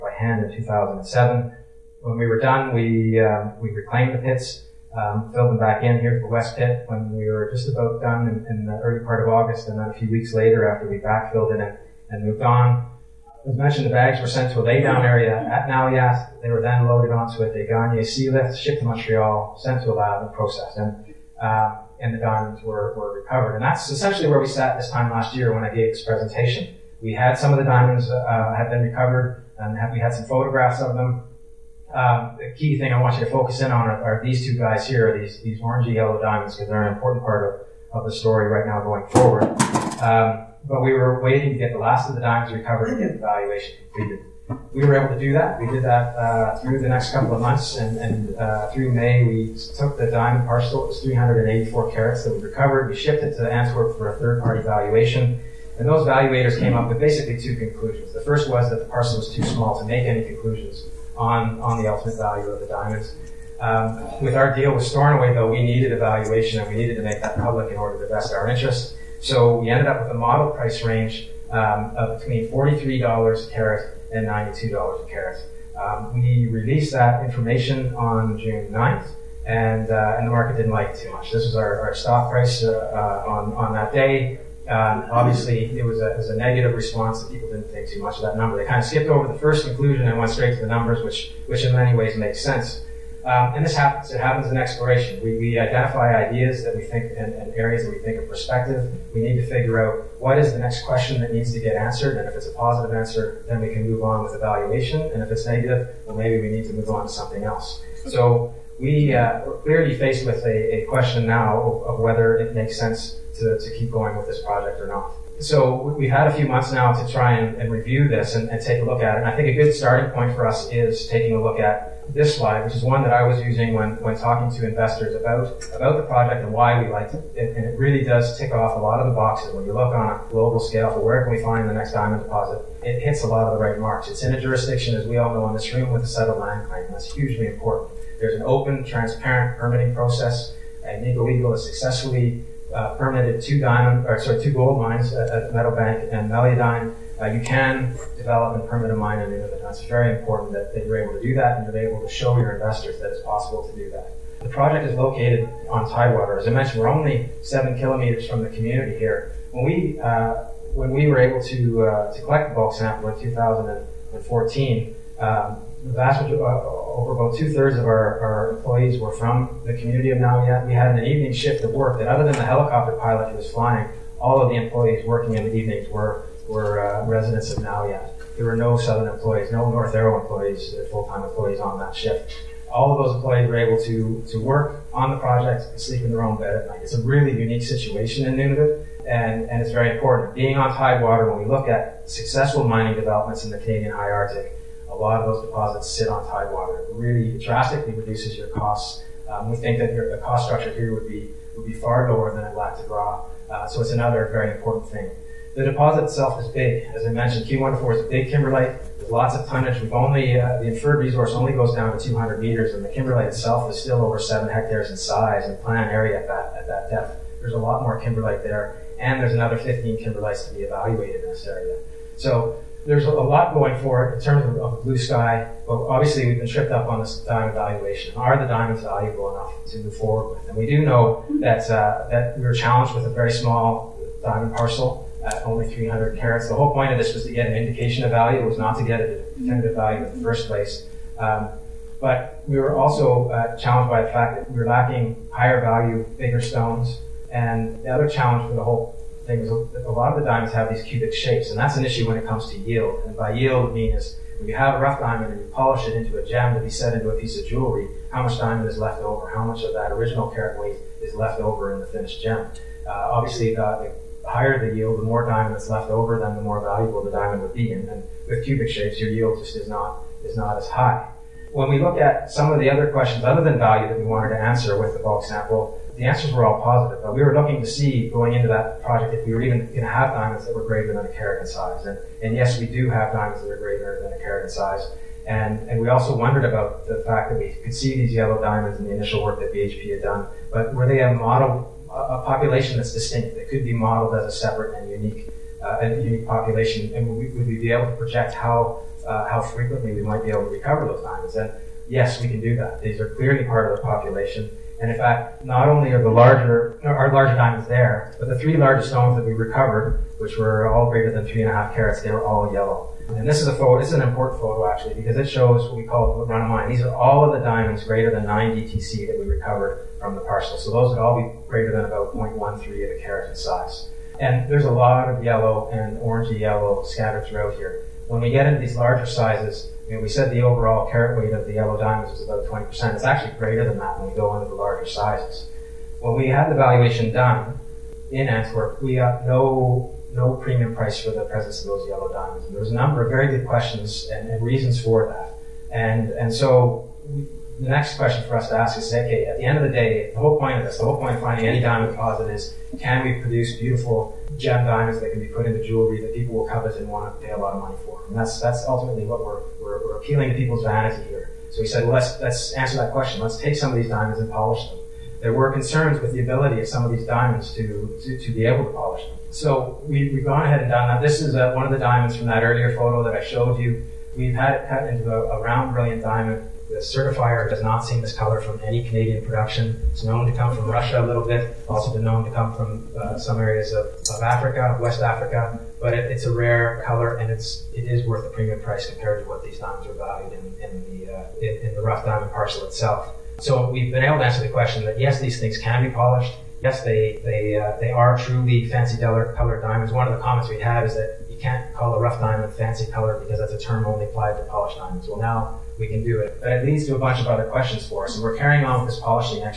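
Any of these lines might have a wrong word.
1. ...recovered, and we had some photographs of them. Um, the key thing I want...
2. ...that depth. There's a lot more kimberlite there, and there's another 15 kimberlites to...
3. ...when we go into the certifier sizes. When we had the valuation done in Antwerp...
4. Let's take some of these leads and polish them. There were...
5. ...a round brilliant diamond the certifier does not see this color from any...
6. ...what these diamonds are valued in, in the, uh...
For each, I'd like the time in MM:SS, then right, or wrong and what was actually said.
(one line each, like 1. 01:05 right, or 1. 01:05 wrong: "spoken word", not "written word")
1. 00:28 right
2. 03:36 right
3. 05:33 wrong: "larger", not "certifier"
4. 06:03 wrong: "diamonds", not "leads"
5. 06:15 right
6. 06:29 right.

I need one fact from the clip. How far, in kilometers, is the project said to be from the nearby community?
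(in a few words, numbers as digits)
7 kilometers.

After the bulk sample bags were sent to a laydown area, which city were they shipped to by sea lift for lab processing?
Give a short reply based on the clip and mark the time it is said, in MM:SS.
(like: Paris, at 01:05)
Montreal, at 00:18.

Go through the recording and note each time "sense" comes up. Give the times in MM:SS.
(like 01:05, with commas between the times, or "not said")
01:32, 01:52.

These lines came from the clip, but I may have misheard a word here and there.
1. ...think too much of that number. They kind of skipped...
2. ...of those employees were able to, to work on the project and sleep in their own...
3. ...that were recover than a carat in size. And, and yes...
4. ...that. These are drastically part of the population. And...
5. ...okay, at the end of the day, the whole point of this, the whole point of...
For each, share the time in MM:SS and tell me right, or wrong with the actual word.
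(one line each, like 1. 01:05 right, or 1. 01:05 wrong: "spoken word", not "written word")
1. 01:27 right
2. 03:02 right
3. 04:40 wrong: "greater", not "recover"
4. 05:02 wrong: "clearly", not "drastically"
5. 05:48 right.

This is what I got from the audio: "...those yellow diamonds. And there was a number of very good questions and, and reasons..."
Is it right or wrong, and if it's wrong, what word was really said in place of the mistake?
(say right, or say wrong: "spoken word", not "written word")
right.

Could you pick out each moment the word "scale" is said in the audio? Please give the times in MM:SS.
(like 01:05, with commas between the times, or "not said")
02:10.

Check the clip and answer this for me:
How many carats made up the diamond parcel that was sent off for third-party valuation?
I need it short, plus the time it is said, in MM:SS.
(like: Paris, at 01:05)
384, at 00:51.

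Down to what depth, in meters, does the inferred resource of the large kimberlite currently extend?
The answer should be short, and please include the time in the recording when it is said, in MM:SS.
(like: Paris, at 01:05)
200 meters, at 03:32.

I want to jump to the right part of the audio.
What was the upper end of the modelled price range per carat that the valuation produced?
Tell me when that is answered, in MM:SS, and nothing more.
01:14.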